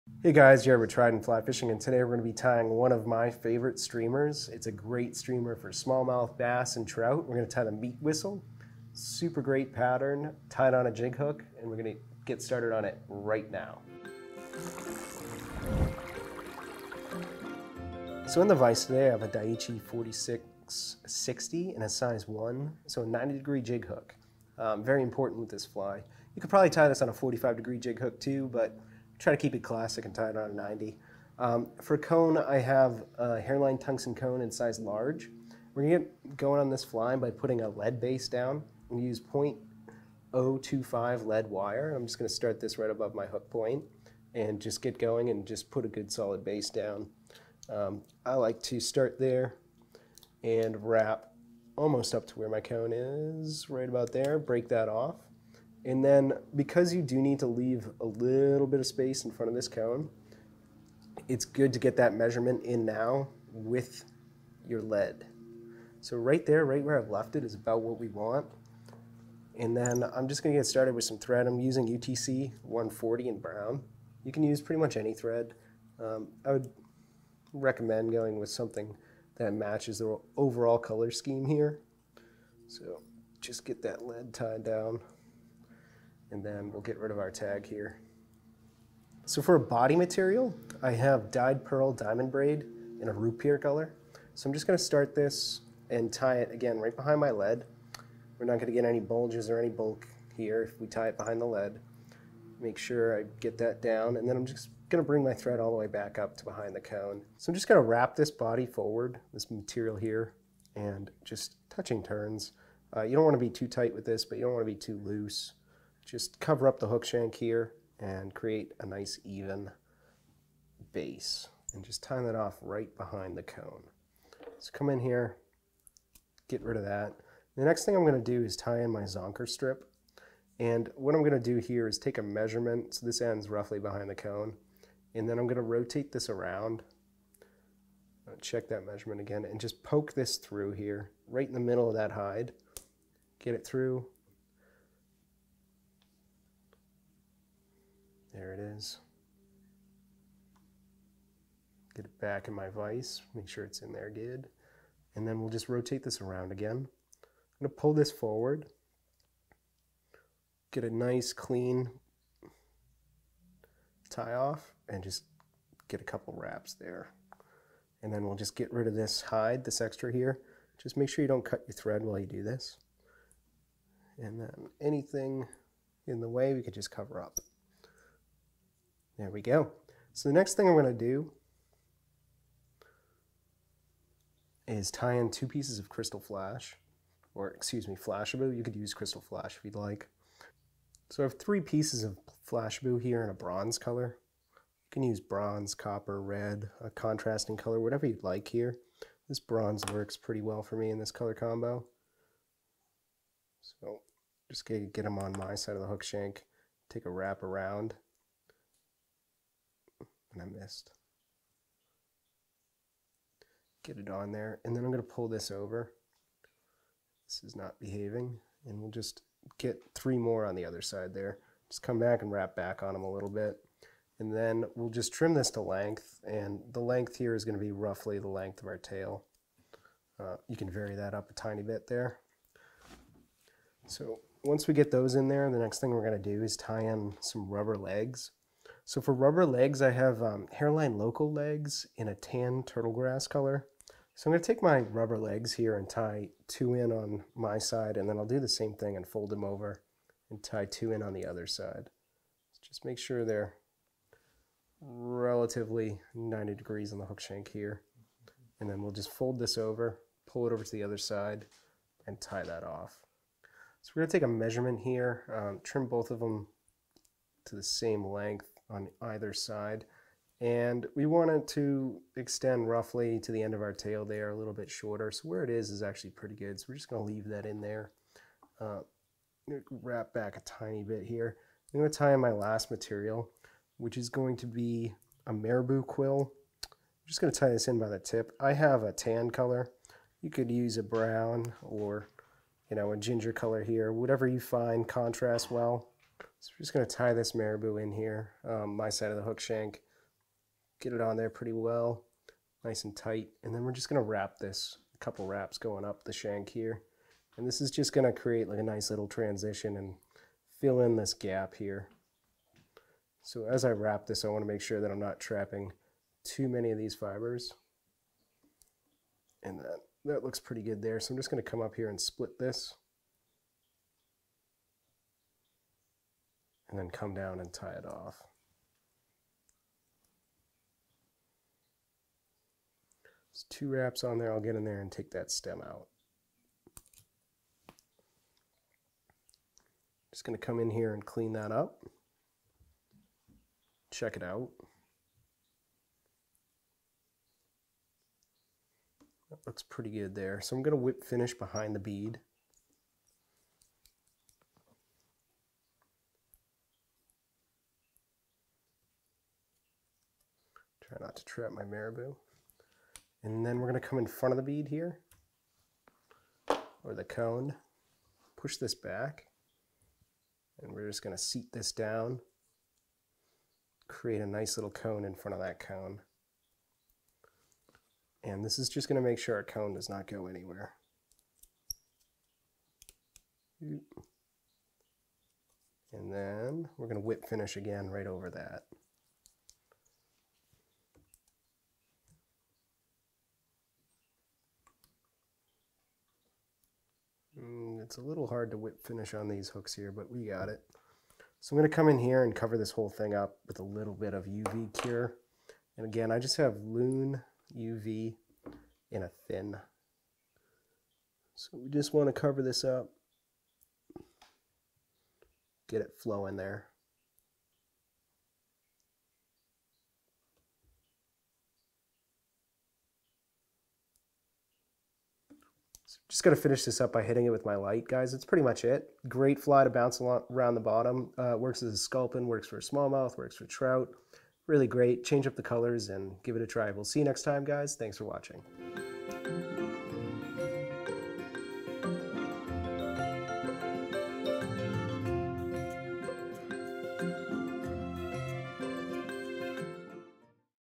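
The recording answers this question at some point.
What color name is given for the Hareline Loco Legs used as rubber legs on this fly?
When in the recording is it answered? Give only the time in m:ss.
4:02.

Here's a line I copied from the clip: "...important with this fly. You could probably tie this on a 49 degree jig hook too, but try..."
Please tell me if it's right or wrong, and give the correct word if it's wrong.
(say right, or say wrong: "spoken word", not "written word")
wrong: "45", not "49".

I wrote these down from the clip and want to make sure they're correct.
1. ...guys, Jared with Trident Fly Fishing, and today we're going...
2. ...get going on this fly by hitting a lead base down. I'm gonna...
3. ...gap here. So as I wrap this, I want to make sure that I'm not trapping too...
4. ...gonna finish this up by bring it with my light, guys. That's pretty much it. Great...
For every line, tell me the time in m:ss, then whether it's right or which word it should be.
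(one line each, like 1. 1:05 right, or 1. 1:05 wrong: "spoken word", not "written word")
1. 0:00 right
2. 0:35 wrong: "putting", not "hitting"
3. 5:11 right
4. 7:06 wrong: "hitting", not "bring".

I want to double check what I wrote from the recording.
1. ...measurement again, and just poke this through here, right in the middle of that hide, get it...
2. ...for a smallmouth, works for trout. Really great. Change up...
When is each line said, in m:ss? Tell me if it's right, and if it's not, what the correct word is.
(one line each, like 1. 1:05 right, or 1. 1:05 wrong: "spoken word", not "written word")
1. 2:18 right
2. 7:12 right.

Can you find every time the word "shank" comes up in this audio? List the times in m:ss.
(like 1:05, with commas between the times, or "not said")
1:57, 3:26, 4:17, 4:59, 5:06.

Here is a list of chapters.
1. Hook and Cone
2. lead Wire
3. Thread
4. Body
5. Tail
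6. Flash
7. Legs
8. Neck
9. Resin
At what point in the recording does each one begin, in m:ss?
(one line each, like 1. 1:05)
1. 0:18
2. 0:43
3. 1:13
4. 1:40
5. 2:10
6. 3:11
7. 4:00
8. 4:57
9. 6:49.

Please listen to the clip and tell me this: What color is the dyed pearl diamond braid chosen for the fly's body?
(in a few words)
root beer.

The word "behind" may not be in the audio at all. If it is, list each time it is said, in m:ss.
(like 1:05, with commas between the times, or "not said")
1:36, 1:41, 1:46, 2:02, 2:13, 5:51.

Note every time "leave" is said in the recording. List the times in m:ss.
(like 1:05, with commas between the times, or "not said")
0:57, 4:37.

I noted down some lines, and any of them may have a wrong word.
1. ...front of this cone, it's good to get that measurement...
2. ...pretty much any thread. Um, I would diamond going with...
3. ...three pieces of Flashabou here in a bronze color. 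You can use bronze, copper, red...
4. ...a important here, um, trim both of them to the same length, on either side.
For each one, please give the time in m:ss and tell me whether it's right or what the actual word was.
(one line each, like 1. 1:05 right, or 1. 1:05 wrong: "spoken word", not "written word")
1. 0:59 right
2. 1:14 wrong: "recommend", not "diamond"
3. 3:11 right
4. 4:24 wrong: "measurement", not "important".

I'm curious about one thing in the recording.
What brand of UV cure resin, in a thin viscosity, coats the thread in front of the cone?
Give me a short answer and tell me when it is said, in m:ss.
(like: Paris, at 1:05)
Loon, at 6:46.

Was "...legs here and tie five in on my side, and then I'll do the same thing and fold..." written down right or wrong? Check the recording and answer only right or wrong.
wrong.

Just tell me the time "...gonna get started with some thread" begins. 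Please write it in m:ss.
1:10.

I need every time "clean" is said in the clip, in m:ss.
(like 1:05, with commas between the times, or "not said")
2:41, 5:41.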